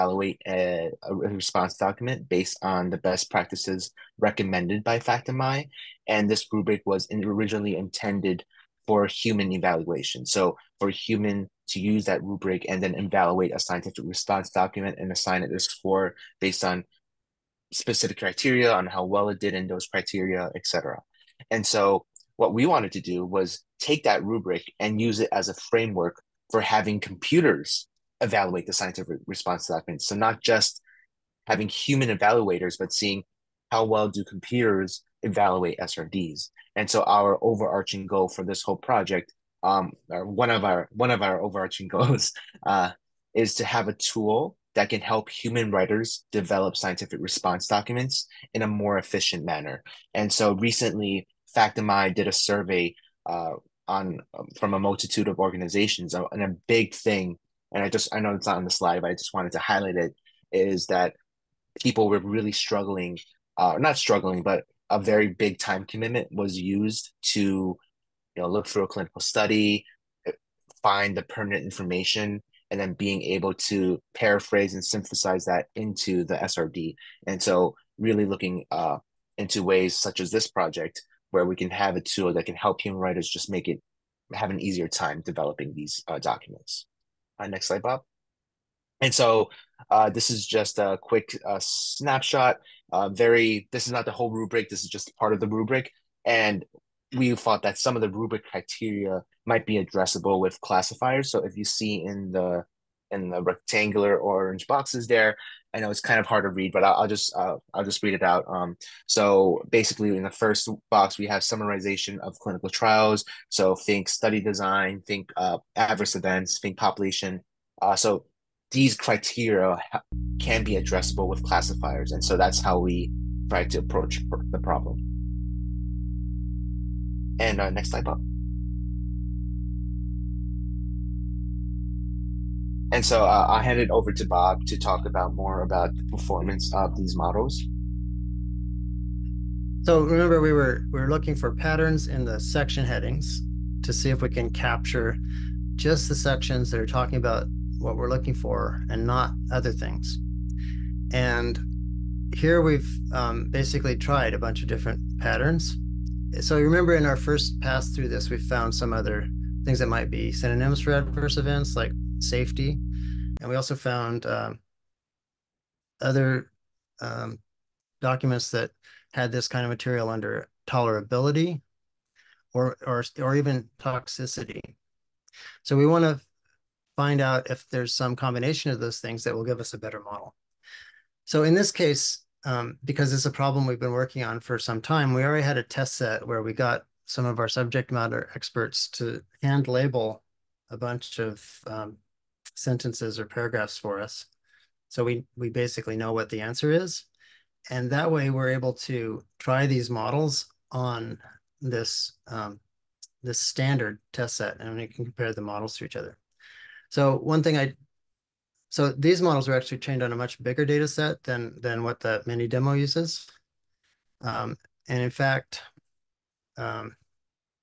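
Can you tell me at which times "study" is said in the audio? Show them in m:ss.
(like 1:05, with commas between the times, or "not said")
1:09, 1:54.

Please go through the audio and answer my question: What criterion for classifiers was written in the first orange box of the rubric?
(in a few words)
summarization of clinical trials.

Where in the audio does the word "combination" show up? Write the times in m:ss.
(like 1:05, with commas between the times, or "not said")
2:58.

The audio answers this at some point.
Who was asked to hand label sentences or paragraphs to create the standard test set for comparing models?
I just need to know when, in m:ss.
3:07.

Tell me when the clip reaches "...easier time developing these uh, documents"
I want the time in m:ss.
1:24.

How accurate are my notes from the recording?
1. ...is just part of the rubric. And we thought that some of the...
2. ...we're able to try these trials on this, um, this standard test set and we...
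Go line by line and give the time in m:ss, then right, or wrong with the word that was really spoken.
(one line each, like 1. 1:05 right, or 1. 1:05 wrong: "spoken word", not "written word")
1. 1:34 right
2. 3:18 wrong: "models", not "trials".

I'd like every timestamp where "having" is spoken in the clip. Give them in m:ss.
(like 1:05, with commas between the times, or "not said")
0:26, 0:31.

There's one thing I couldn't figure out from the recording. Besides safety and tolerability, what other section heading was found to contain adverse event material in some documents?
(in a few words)
toxicity.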